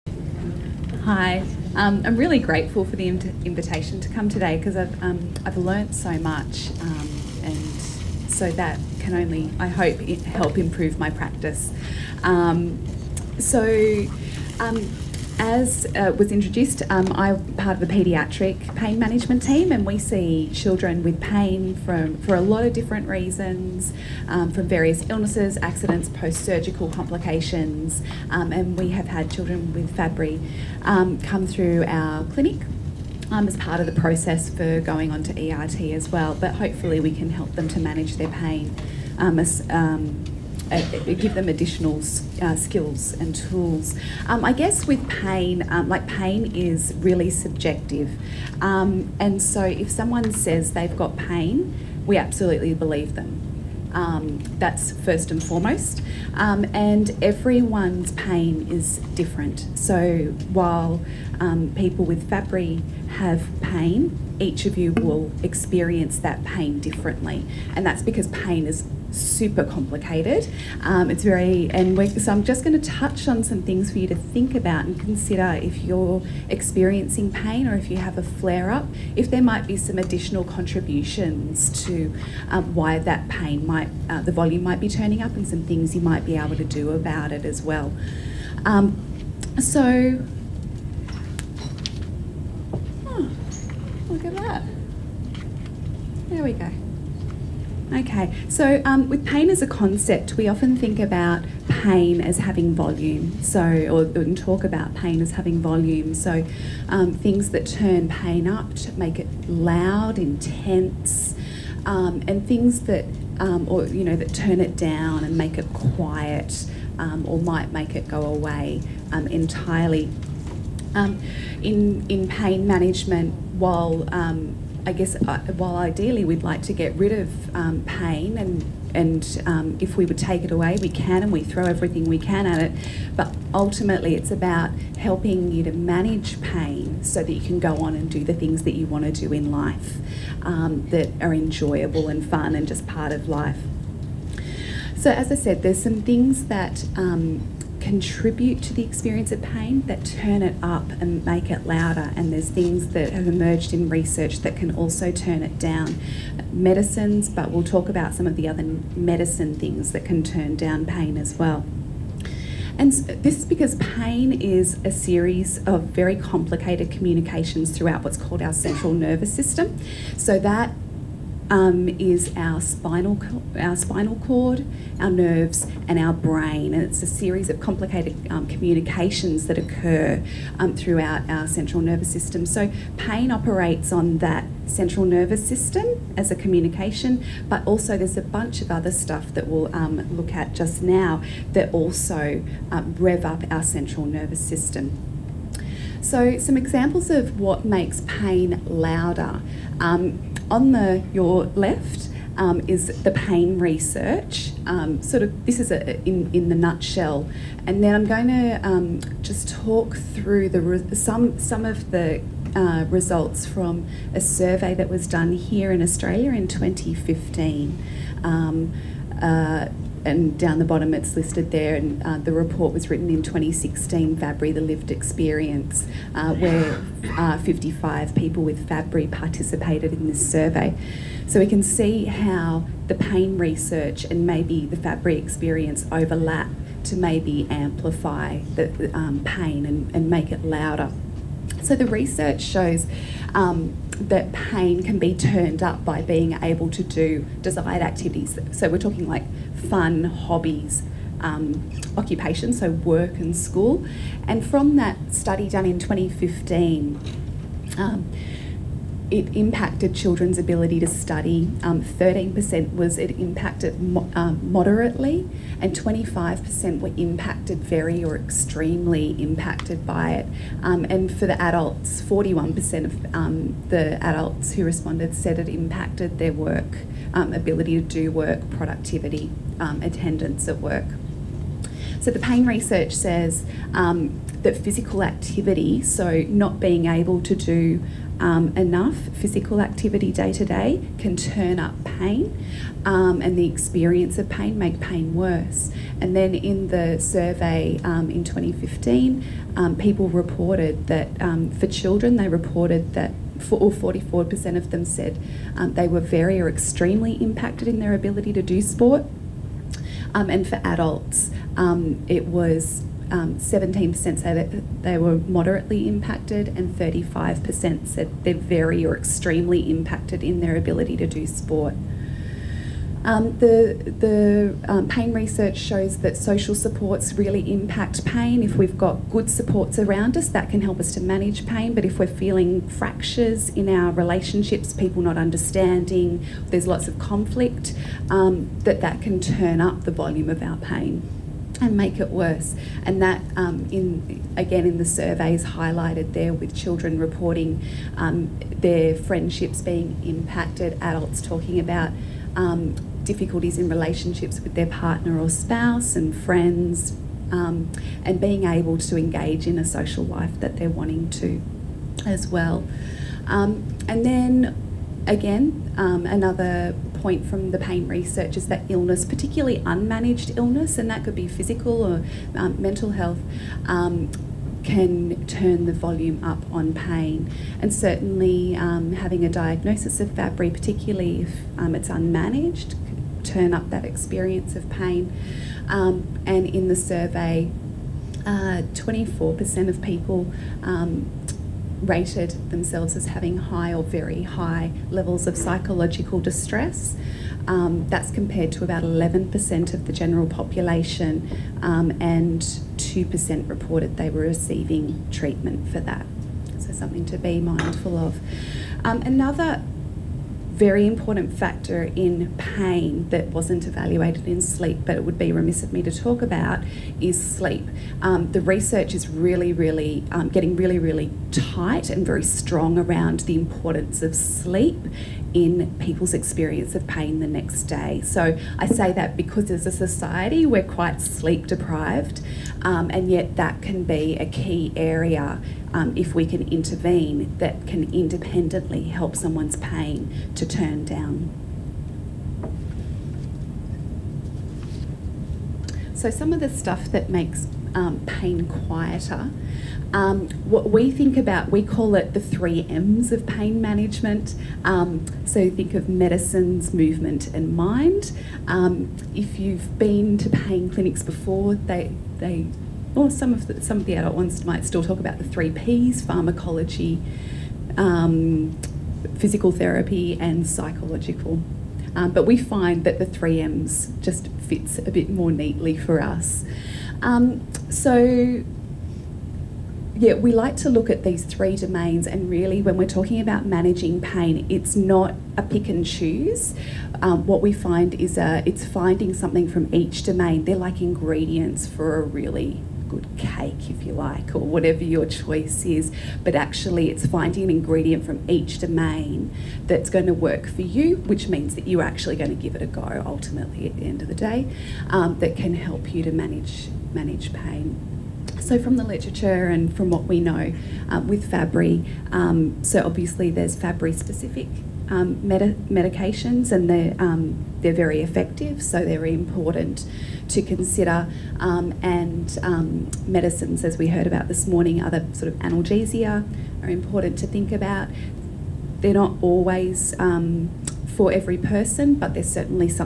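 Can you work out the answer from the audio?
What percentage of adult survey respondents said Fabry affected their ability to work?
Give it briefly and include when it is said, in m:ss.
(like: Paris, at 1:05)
41%, at 4:32.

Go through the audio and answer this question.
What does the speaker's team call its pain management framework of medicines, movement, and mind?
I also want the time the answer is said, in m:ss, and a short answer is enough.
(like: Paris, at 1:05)
three M's, at 7:32.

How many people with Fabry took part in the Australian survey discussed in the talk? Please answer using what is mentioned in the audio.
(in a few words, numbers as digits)
55.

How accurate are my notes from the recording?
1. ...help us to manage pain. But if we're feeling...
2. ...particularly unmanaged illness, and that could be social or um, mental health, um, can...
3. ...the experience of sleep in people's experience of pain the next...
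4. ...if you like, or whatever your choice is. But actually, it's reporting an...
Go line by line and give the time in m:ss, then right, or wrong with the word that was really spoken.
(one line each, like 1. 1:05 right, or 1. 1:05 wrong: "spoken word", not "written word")
1. 5:30 right
2. 6:09 wrong: "physical", not "social"
3. 7:03 wrong: "importance", not "experience"
4. 8:13 wrong: "finding", not "reporting".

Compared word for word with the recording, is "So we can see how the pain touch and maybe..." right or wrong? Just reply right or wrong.
wrong.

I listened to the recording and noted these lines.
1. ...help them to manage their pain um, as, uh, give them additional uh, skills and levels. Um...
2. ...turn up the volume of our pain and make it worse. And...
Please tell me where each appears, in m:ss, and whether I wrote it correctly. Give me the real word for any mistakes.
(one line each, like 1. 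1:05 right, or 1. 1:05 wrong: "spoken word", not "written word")
1. 0:37 wrong: "tools", not "levels"
2. 5:39 right.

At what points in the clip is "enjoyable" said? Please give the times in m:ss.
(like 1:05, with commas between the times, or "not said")
2:21.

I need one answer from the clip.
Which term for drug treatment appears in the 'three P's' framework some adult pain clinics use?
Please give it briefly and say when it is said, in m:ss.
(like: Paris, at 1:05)
pharmacology, at 7:46.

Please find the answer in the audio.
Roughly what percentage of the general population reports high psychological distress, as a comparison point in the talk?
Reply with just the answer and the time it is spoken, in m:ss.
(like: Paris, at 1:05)
11%, at 6:38.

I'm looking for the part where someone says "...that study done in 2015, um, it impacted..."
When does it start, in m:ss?
4:14.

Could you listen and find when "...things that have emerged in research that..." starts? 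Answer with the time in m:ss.
2:32.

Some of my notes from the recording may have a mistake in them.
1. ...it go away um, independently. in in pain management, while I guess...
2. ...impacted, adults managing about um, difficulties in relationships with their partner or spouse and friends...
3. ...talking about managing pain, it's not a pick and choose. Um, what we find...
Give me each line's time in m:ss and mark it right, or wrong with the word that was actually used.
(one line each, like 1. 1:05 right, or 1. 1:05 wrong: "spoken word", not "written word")
1. 1:57 wrong: "entirely", not "independently"
2. 5:50 wrong: "talking", not "managing"
3. 8:02 right.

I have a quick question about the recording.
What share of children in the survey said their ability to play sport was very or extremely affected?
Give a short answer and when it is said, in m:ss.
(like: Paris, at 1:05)
44%, at 5:03.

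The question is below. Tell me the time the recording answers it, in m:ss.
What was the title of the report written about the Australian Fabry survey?
3:44.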